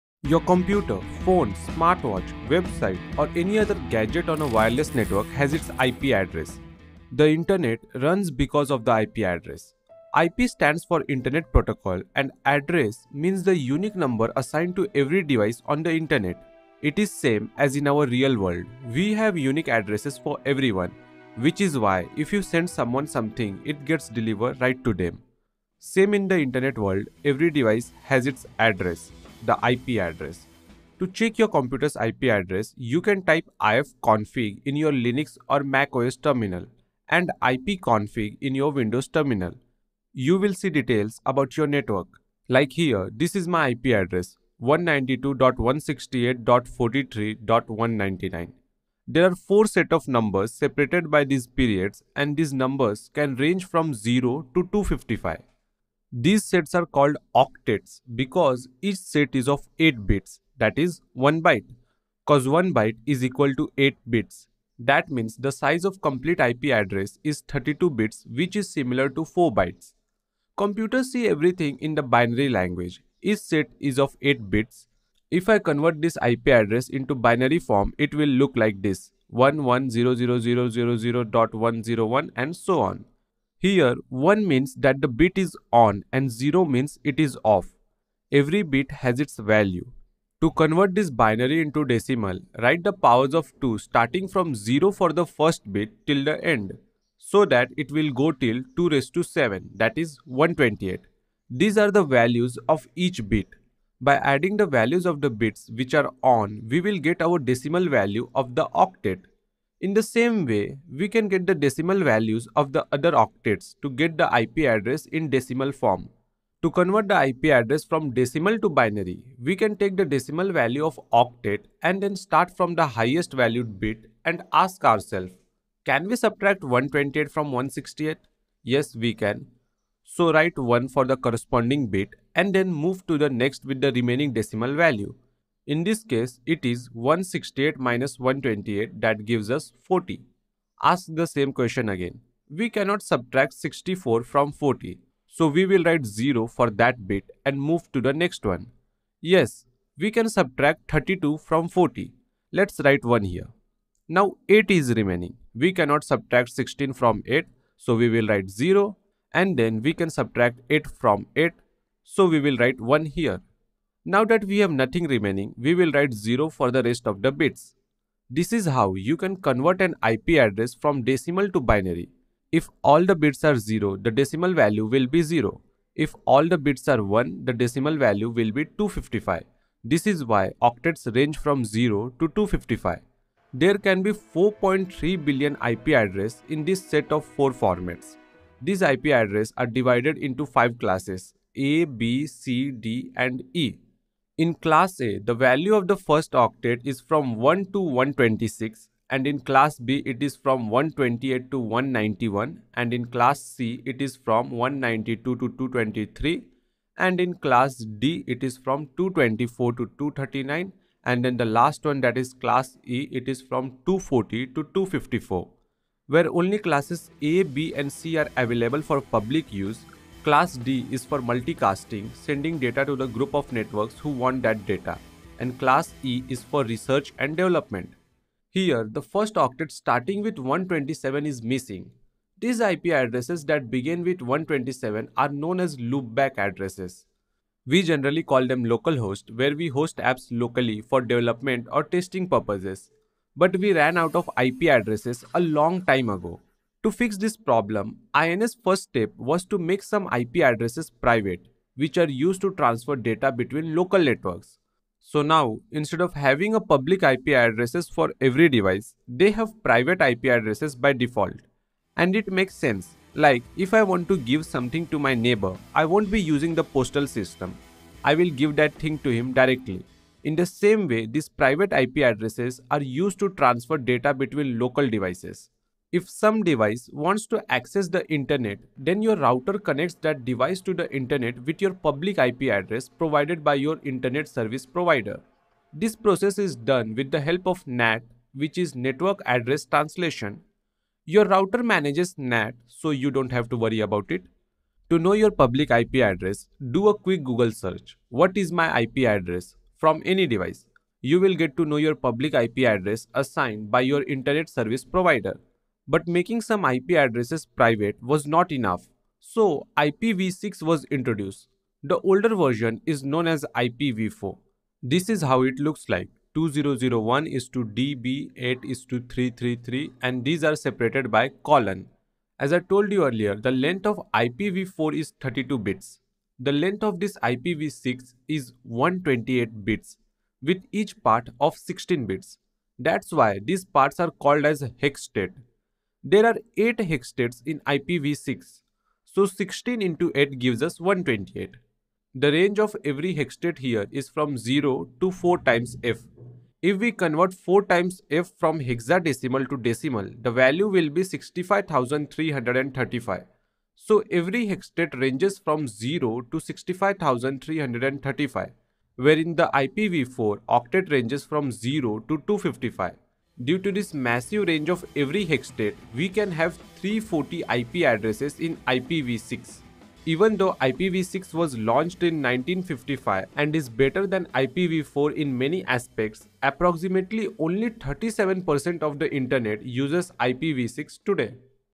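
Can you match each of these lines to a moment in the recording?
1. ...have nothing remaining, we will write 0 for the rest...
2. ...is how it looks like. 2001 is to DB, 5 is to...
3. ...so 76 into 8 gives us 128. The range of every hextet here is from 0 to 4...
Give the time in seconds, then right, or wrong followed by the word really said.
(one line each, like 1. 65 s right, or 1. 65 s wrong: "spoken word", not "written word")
1. 164 s right
2. 315 s wrong: "8", not "5"
3. 339 s wrong: "16", not "76".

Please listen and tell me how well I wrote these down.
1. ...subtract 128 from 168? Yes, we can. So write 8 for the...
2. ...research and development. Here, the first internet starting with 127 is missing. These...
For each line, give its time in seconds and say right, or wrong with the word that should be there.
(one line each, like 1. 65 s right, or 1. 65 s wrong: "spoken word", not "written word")
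1. 126 s wrong: "1", not "8"
2. 226 s wrong: "octet", not "internet".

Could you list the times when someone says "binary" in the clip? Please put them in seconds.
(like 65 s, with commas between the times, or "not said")
72 s, 77 s, 91 s, 118 s, 171 s.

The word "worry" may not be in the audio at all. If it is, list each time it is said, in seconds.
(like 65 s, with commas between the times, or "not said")
293 s.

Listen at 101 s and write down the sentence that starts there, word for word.
These are the values of each bit.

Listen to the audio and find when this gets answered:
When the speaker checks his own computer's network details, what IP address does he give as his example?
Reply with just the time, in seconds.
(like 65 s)
44 s.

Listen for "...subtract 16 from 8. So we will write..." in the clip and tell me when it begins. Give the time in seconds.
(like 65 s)
156 s.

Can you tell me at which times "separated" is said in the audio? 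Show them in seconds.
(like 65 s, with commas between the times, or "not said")
50 s, 320 s.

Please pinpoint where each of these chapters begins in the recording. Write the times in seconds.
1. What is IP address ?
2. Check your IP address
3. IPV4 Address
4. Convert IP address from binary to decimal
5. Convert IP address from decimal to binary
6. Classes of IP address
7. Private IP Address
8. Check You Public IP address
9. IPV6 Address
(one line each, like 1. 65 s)
1. 11 s
2. 30 s
3. 49 s
4. 74 s
5. 109 s
6. 184 s
7. 243 s
8. 285 s
9. 308 s.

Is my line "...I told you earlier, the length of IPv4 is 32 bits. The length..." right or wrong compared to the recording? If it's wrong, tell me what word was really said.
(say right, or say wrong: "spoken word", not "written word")
right.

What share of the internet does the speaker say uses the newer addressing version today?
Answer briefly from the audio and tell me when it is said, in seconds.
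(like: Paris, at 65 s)
37%, at 377 s.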